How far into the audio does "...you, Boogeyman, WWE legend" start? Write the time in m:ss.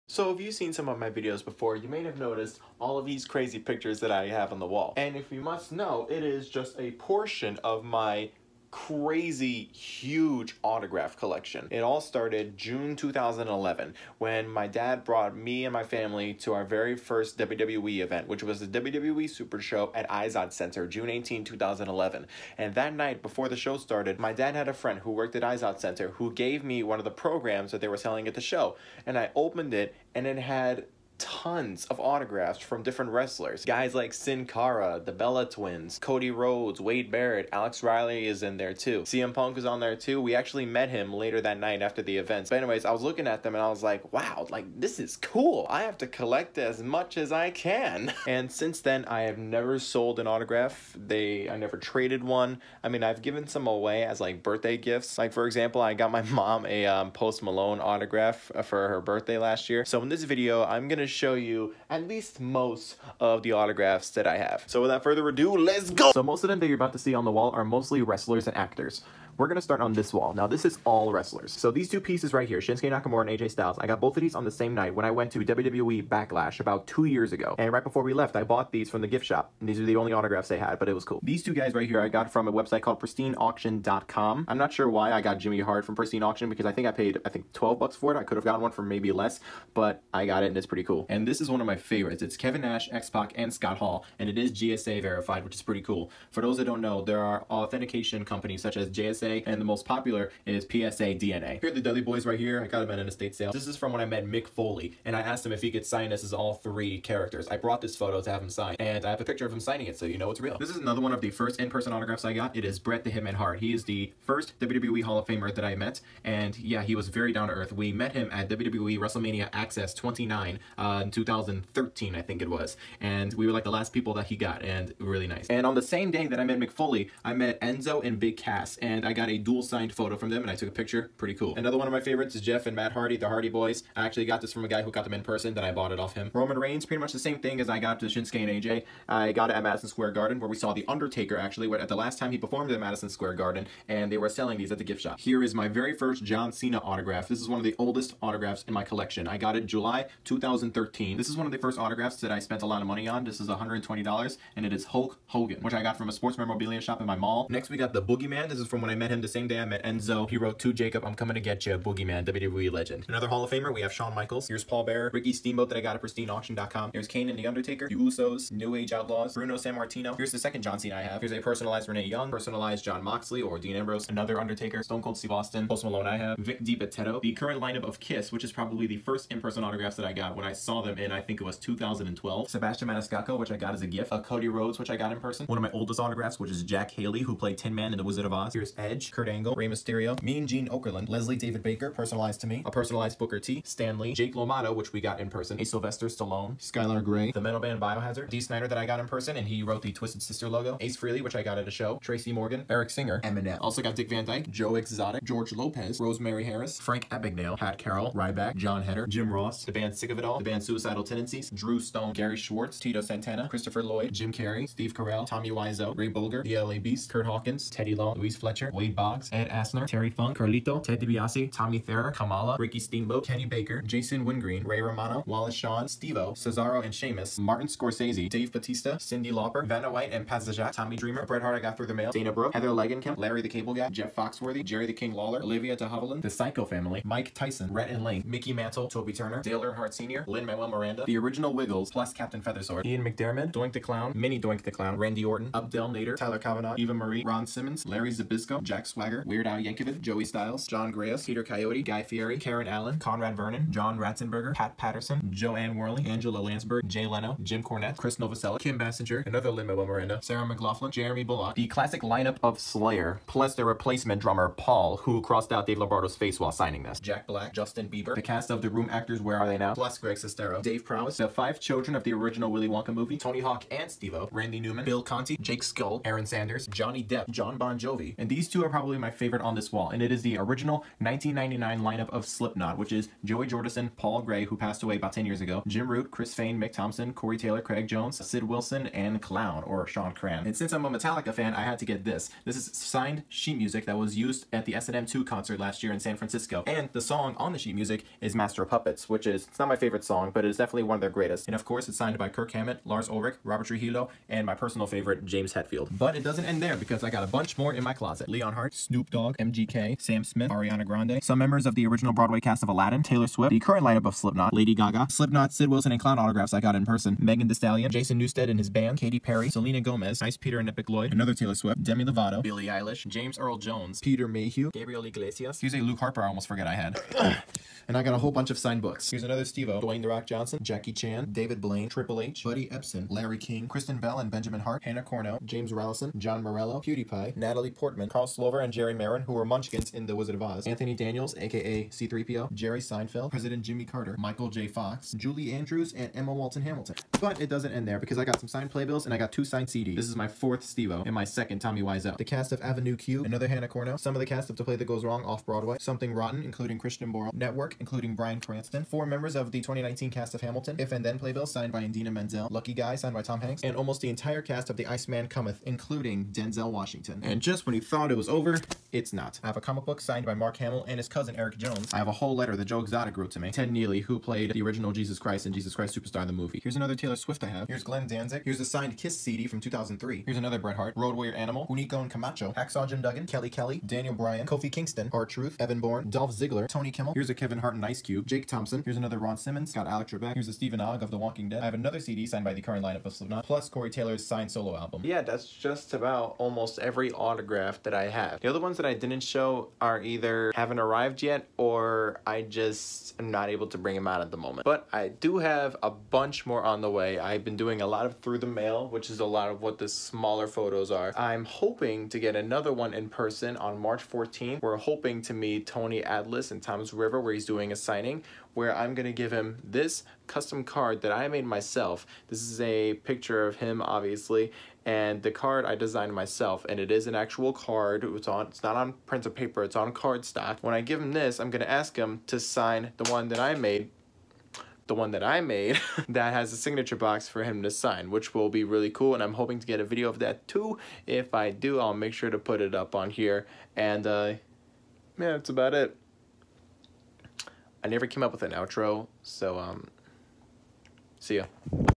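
2:41.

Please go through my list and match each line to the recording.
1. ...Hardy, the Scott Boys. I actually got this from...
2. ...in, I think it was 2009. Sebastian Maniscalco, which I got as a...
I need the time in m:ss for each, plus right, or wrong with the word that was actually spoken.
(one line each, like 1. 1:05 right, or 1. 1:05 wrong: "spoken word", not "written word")
1. 2:12 wrong: "Hardy", not "Scott"
2. 3:00 wrong: "2012", not "2009".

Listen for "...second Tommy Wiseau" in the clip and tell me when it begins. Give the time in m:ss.
5:51.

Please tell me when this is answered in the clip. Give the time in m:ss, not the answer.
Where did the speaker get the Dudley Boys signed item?
1:42.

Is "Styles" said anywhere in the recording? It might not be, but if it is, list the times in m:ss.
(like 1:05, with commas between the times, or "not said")
1:13, 4:10.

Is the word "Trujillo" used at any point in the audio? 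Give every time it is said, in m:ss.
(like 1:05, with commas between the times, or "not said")
5:03.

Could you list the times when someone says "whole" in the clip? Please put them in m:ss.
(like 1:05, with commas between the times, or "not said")
5:28, 6:12.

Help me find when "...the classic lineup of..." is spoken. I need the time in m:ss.
4:21.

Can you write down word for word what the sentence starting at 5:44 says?
Fox, Julie Andrews, and Emma Walton Hamilton.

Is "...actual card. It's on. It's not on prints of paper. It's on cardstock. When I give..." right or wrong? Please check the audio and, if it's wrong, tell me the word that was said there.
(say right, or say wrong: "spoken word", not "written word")
right.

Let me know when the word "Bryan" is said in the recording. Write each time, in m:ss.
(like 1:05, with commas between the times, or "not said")
5:58, 6:24.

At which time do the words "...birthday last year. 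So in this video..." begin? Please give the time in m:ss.
0:59.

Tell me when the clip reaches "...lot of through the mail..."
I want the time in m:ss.
6:47.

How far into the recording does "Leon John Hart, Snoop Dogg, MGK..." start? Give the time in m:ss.
5:08.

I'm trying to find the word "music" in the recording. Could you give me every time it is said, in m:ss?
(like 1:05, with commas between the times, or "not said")
4:53, 4:57.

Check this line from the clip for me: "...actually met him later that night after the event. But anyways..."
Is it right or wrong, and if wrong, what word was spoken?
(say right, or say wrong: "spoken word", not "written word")
right.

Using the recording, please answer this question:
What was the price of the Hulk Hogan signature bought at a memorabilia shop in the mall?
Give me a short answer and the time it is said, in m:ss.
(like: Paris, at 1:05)
$120, at 2:33.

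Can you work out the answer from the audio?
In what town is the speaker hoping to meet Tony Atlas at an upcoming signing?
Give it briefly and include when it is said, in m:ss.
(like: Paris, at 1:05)
Toms River, at 6:56.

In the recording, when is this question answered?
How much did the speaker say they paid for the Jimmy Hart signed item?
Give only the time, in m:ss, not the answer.
1:27.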